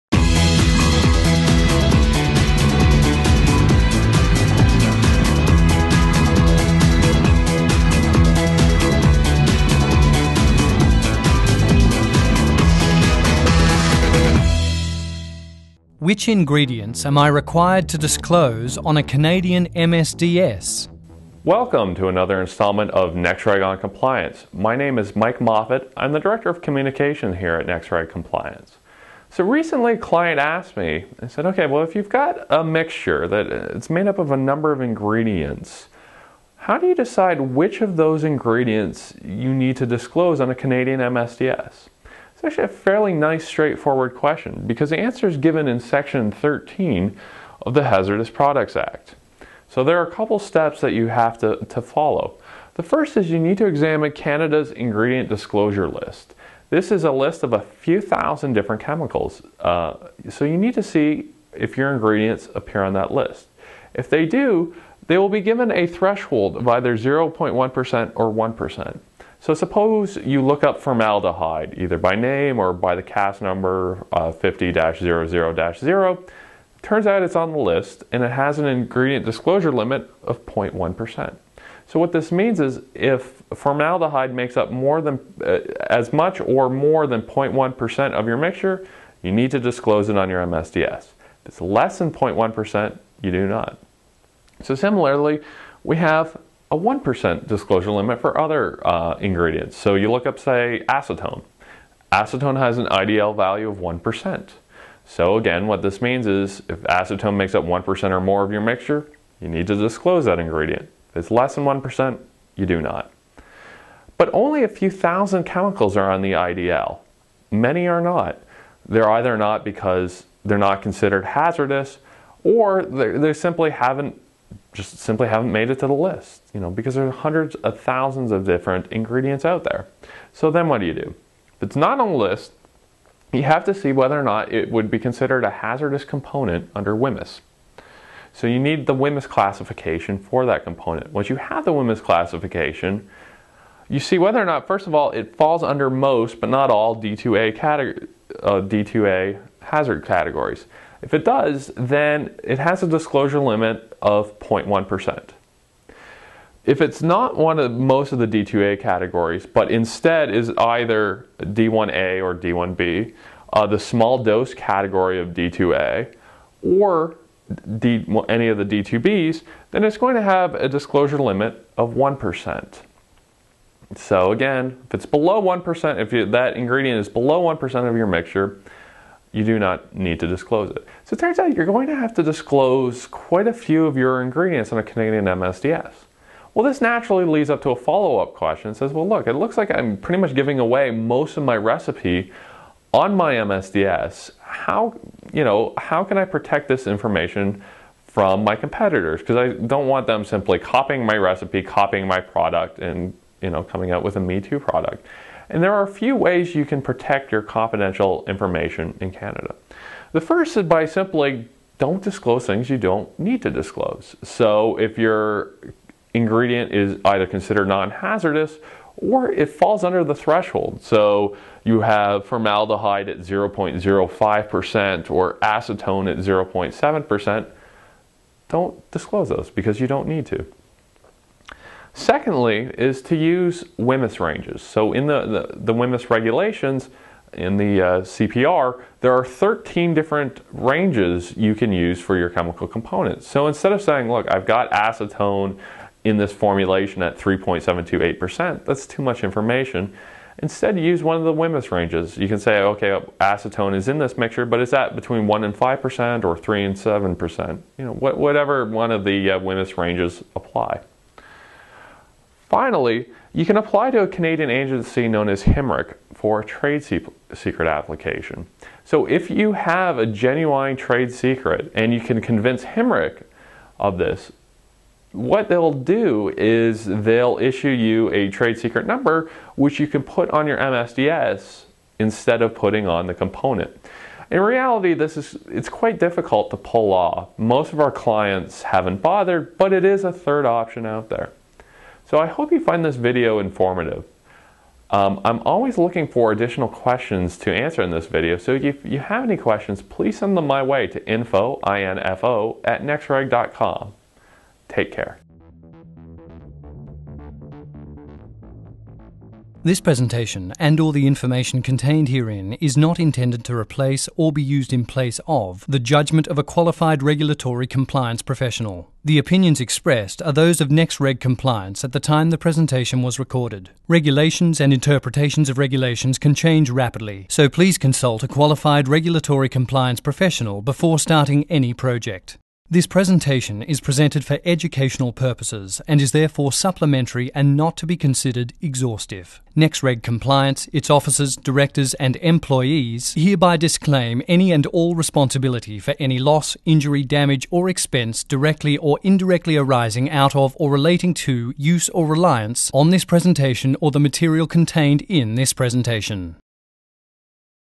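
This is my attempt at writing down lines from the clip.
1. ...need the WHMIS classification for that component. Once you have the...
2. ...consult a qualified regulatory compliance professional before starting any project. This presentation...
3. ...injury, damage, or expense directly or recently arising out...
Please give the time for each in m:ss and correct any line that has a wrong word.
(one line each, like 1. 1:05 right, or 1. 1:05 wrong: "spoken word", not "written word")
1. 2:18 right
2. 5:27 right
3. 5:46 wrong: "indirectly", not "recently".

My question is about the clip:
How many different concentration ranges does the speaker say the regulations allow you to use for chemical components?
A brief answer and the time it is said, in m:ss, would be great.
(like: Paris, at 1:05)
13, at 3:59.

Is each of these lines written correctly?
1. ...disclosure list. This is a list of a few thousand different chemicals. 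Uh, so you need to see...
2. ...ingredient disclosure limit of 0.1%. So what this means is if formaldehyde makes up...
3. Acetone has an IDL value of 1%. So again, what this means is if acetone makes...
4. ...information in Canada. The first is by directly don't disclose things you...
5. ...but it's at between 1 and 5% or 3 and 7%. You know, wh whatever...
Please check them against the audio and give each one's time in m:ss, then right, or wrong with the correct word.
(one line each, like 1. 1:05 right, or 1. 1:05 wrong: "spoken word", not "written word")
1. 0:55 right
2. 1:18 right
3. 1:42 right
4. 3:28 wrong: "simply", not "directly"
5. 4:14 right.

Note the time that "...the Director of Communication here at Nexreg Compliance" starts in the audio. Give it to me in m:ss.
0:26.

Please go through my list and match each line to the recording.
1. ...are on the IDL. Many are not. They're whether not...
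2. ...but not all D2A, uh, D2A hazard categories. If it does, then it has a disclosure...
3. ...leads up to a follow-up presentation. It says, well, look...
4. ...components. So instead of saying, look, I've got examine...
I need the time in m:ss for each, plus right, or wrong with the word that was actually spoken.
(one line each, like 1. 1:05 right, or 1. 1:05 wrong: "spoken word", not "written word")
1. 1:55 wrong: "either", not "whether"
2. 2:26 right
3. 3:07 wrong: "question", not "presentation"
4. 4:02 wrong: "acetone", not "examine".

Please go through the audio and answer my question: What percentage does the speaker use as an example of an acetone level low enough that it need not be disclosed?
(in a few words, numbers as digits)
0.7%.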